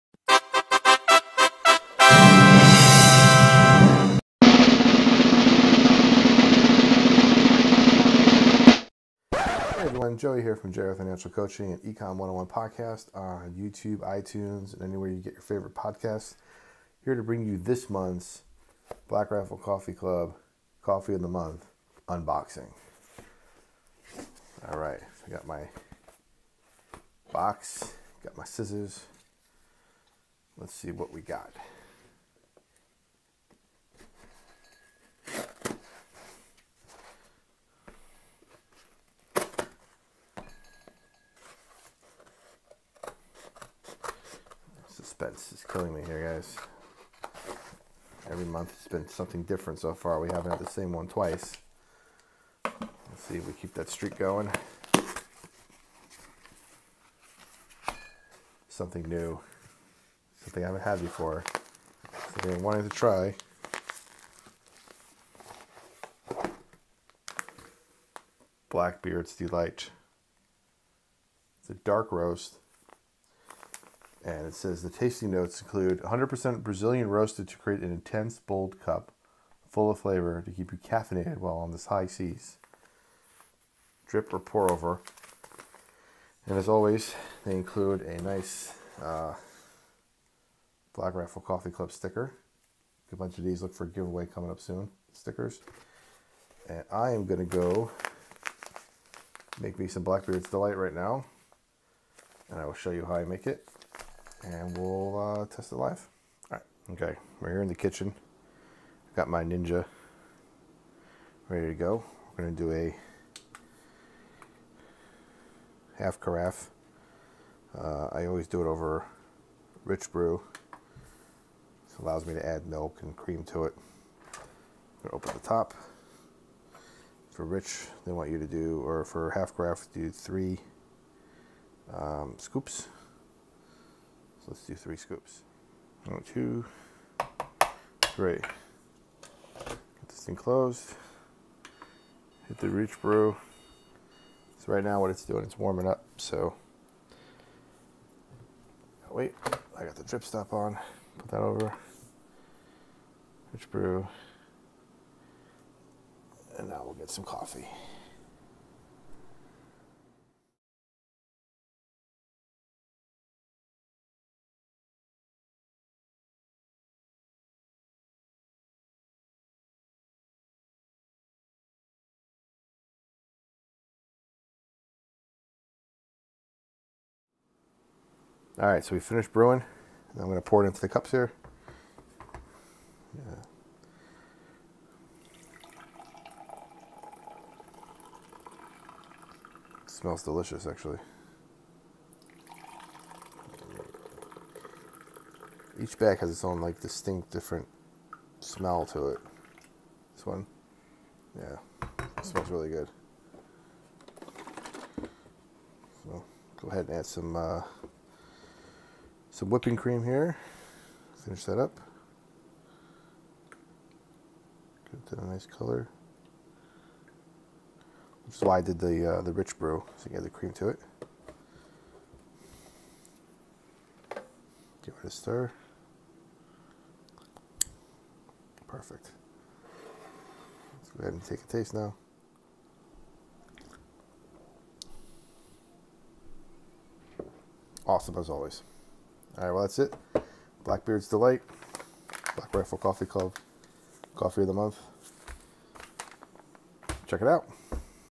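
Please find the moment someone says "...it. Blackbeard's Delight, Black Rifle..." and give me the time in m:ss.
3:59.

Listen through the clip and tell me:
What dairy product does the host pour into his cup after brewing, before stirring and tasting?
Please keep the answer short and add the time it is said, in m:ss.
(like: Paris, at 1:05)
whipping cream, at 3:29.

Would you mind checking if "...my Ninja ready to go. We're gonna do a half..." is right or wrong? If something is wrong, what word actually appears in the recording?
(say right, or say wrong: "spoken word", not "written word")
right.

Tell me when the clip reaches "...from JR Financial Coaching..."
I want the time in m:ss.
0:10.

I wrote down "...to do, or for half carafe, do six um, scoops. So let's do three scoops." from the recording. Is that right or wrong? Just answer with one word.
wrong.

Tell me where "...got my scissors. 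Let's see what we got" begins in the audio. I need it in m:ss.
0:28.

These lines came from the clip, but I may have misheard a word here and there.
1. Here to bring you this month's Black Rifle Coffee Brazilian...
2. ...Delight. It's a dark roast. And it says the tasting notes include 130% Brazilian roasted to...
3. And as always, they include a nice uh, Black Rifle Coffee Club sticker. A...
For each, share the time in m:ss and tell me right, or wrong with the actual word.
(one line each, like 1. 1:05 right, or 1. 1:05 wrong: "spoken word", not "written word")
1. 0:17 wrong: "Club", not "Brazilian"
2. 1:09 wrong: "100", not "130"
3. 1:26 right.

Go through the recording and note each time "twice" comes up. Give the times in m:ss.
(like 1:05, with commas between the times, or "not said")
0:51.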